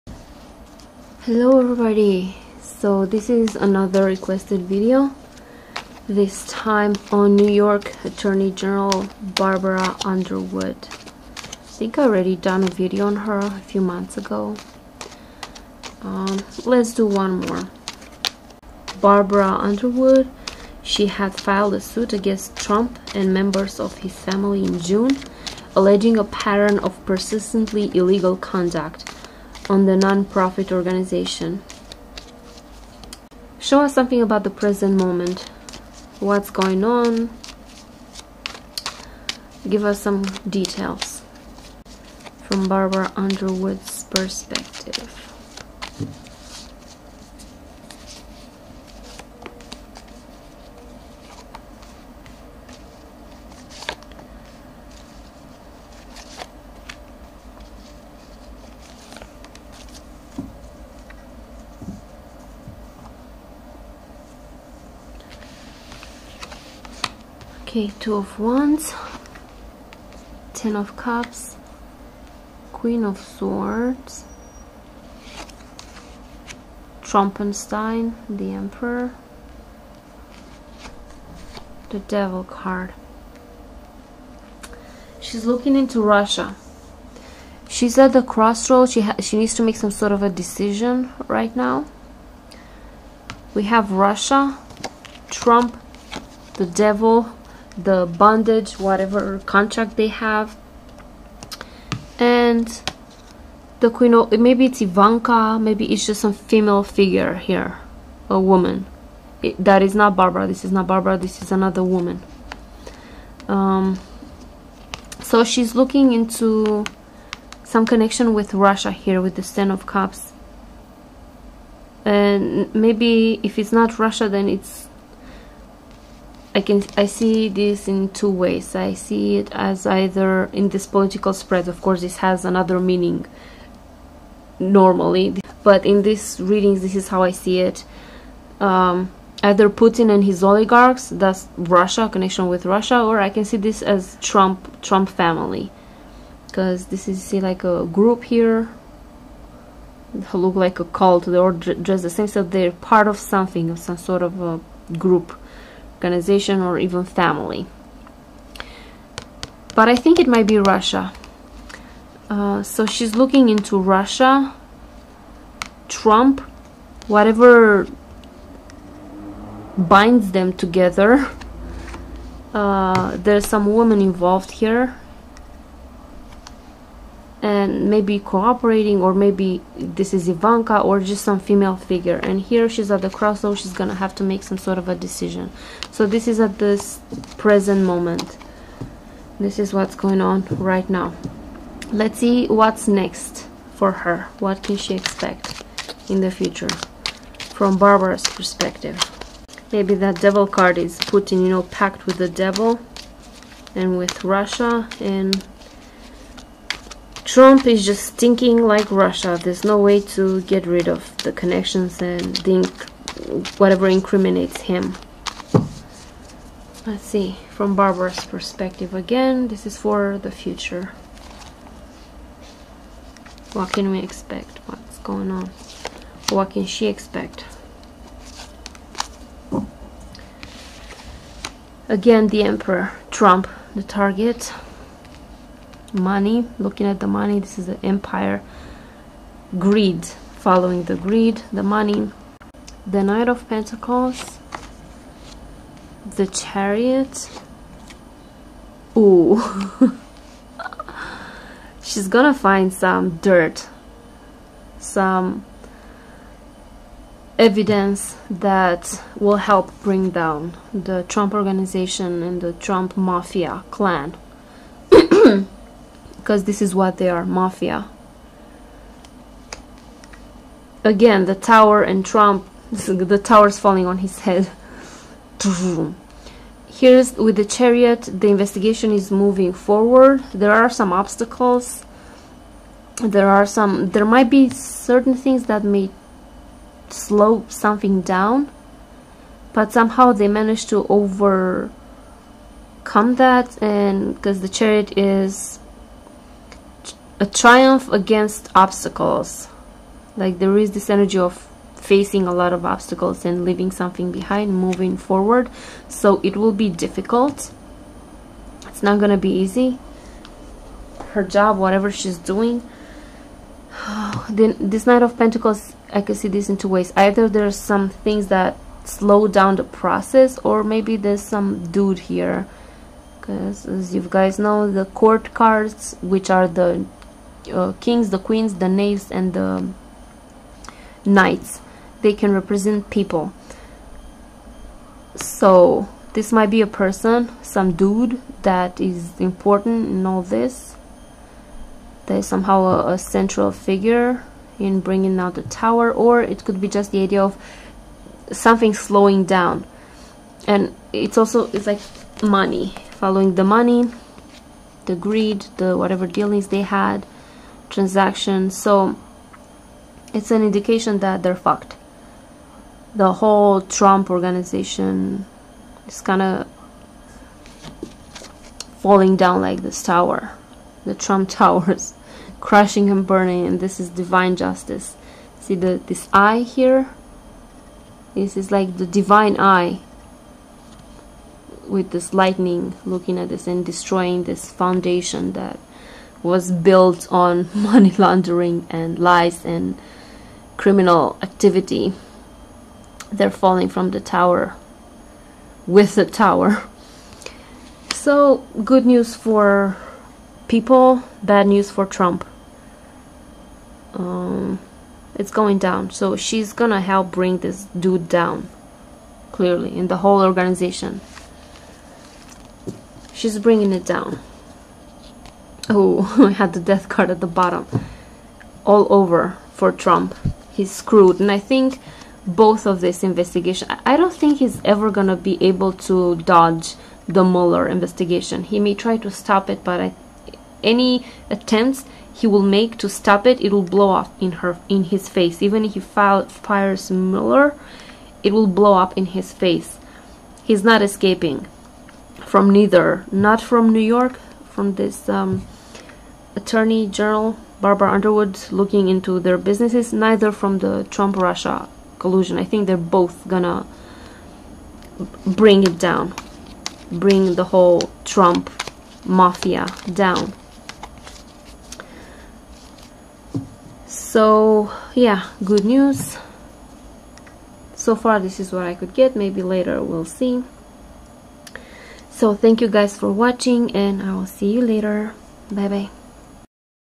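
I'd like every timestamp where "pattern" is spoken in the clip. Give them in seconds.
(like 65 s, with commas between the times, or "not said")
26 s.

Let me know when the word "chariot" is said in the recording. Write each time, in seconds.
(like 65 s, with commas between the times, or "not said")
246 s, 277 s, 294 s.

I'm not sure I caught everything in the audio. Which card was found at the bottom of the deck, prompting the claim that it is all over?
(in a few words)
the Death card.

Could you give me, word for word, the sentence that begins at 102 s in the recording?
And the Queen of, maybe it's Ivanka, maybe it's just some female figure here, a woman.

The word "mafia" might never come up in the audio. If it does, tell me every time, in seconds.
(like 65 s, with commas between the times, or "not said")
262 s, 267 s, 459 s.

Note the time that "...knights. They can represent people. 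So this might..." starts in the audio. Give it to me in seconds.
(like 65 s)
331 s.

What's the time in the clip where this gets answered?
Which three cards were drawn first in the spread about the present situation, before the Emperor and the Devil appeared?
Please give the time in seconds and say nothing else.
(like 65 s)
68 s.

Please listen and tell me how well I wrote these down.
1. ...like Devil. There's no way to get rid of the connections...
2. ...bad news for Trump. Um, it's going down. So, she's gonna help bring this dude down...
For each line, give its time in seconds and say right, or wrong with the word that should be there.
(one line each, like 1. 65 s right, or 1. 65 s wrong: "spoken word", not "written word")
1. 208 s wrong: "Russia", not "Devil"
2. 401 s right.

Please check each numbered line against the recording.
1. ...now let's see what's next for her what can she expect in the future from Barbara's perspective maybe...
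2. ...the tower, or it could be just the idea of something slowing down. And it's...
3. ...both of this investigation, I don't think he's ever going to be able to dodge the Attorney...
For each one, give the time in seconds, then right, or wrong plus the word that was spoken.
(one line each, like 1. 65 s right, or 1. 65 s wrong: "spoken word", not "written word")
1. 190 s right
2. 345 s right
3. 422 s wrong: "Mueller", not "Attorney".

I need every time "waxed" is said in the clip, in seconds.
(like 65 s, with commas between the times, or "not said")
not said.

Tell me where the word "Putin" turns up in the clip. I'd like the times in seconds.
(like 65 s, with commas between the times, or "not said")
139 s, 200 s.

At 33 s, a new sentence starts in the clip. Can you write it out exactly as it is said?
Show us something about the present moment.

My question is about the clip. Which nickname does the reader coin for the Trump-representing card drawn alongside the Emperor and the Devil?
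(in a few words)
Trompenstein.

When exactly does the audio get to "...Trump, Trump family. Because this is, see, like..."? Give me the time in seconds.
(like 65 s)
144 s.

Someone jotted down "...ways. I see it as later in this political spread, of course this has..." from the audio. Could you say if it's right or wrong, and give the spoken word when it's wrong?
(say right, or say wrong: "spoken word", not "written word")
wrong: "either", not "later".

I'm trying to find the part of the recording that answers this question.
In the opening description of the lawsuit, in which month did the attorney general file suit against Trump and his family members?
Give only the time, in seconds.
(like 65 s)
24 s.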